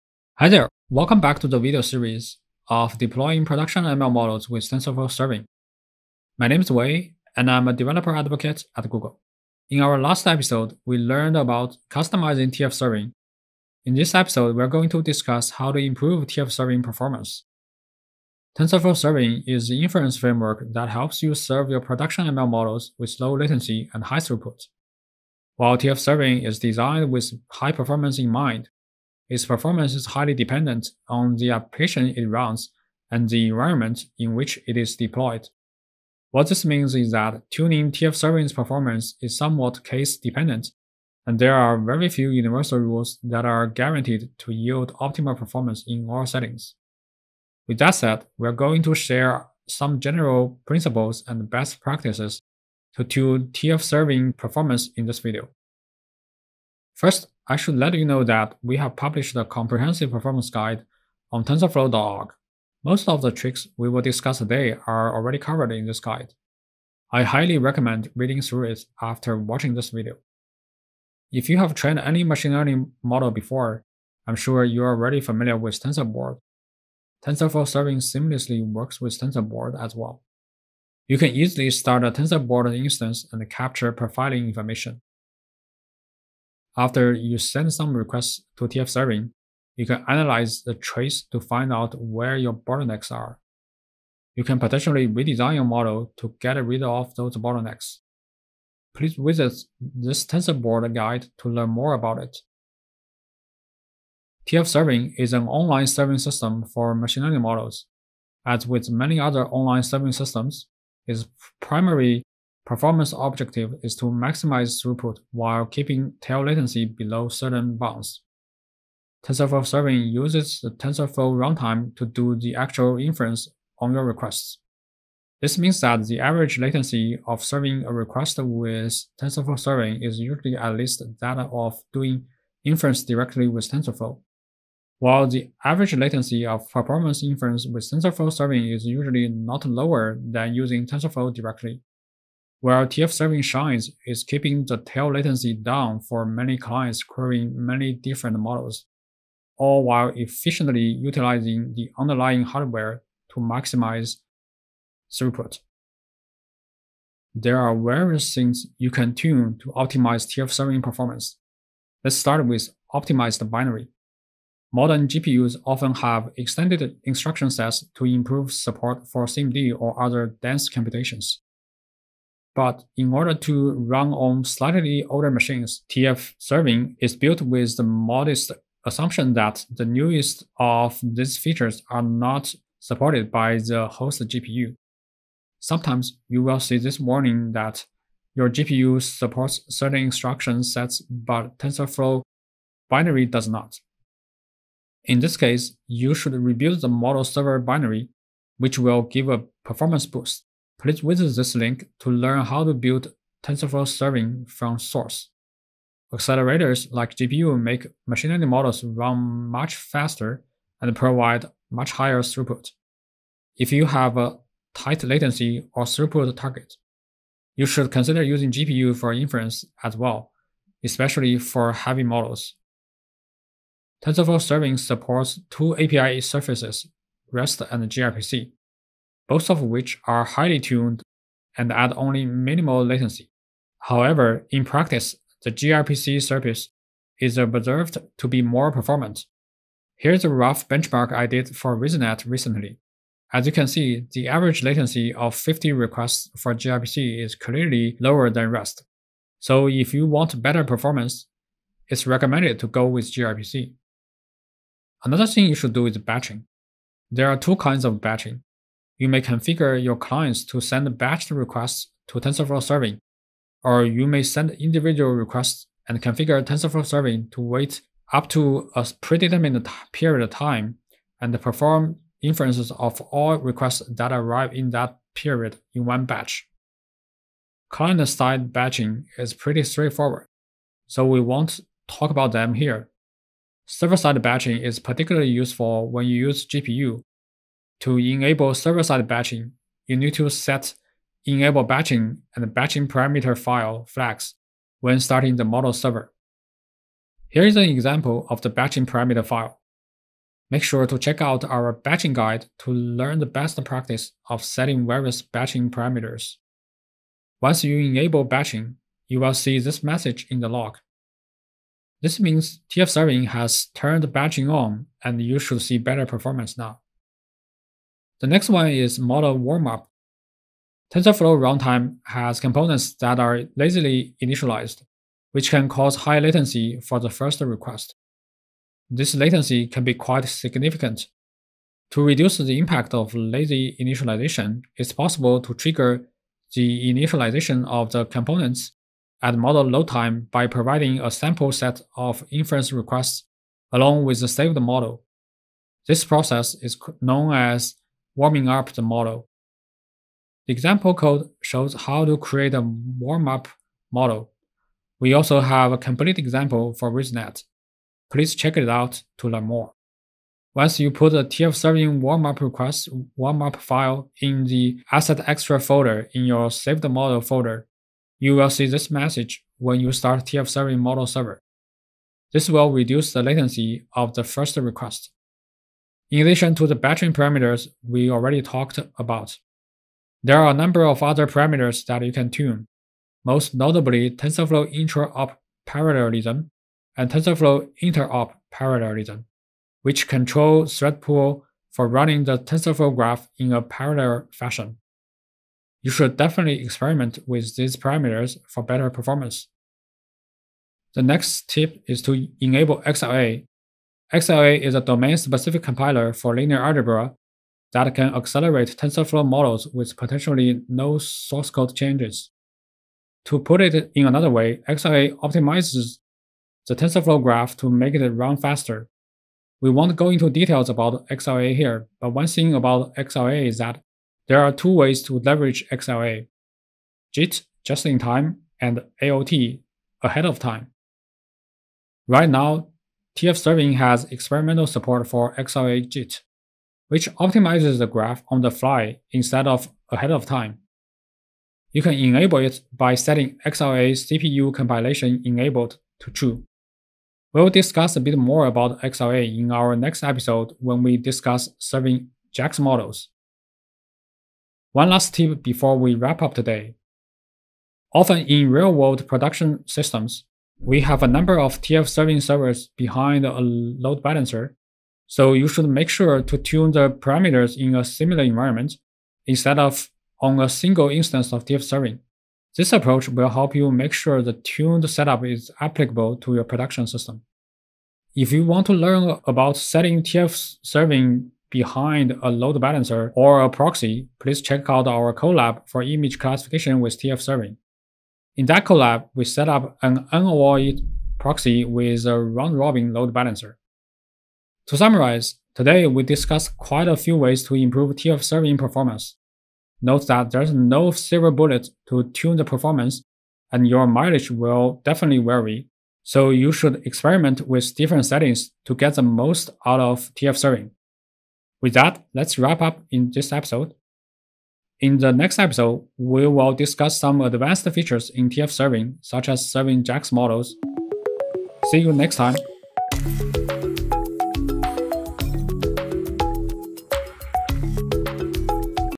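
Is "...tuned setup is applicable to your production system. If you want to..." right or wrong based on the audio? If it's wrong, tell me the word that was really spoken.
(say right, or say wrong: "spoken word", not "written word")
right.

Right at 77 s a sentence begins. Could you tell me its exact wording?
TensorFlow serving seamlessly works with TensorBoard as well.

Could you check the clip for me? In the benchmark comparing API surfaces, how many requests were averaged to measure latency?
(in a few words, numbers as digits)
50.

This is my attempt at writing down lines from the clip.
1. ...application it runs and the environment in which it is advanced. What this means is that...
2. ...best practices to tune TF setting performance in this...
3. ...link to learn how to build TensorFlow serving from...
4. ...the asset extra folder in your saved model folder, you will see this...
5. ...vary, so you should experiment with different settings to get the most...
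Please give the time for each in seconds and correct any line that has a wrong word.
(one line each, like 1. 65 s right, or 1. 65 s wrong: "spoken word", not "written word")
1. 31 s wrong: "deployed", not "advanced"
2. 51 s wrong: "serving", not "setting"
3. 201 s right
4. 364 s right
5. 505 s right.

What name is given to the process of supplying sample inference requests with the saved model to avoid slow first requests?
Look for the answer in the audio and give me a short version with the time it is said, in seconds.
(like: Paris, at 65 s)
warming up the model, at 348 s.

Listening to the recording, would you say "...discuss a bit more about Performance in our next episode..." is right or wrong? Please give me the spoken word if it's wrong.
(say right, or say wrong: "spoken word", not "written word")
wrong: "XLA", not "Performance".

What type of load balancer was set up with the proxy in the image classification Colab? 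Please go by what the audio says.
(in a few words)
round-robin.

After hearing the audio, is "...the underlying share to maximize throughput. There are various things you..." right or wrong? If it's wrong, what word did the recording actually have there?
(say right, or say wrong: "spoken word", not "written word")
wrong: "hardware", not "share".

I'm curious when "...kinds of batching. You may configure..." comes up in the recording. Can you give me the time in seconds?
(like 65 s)
257 s.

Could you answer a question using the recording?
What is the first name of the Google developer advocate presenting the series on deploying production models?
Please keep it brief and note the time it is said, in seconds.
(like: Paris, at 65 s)
Wei, at 6 s.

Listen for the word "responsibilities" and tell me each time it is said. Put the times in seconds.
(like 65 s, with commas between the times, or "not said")
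not said.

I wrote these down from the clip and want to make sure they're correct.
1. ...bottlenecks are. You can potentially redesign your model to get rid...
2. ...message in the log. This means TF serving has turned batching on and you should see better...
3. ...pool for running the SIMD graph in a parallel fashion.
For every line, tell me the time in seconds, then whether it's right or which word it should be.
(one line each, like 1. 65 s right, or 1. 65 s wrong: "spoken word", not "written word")
1. 92 s right
2. 309 s right
3. 391 s wrong: "TensorFlow", not "SIMD".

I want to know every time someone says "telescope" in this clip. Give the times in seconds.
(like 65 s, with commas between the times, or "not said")
not said.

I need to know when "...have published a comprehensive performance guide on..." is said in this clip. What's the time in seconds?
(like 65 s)
58 s.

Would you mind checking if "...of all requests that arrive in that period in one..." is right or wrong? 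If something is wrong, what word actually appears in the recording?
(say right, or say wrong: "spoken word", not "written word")
right.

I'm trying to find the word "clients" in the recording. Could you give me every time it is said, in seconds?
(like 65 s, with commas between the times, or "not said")
146 s, 259 s, 277 s.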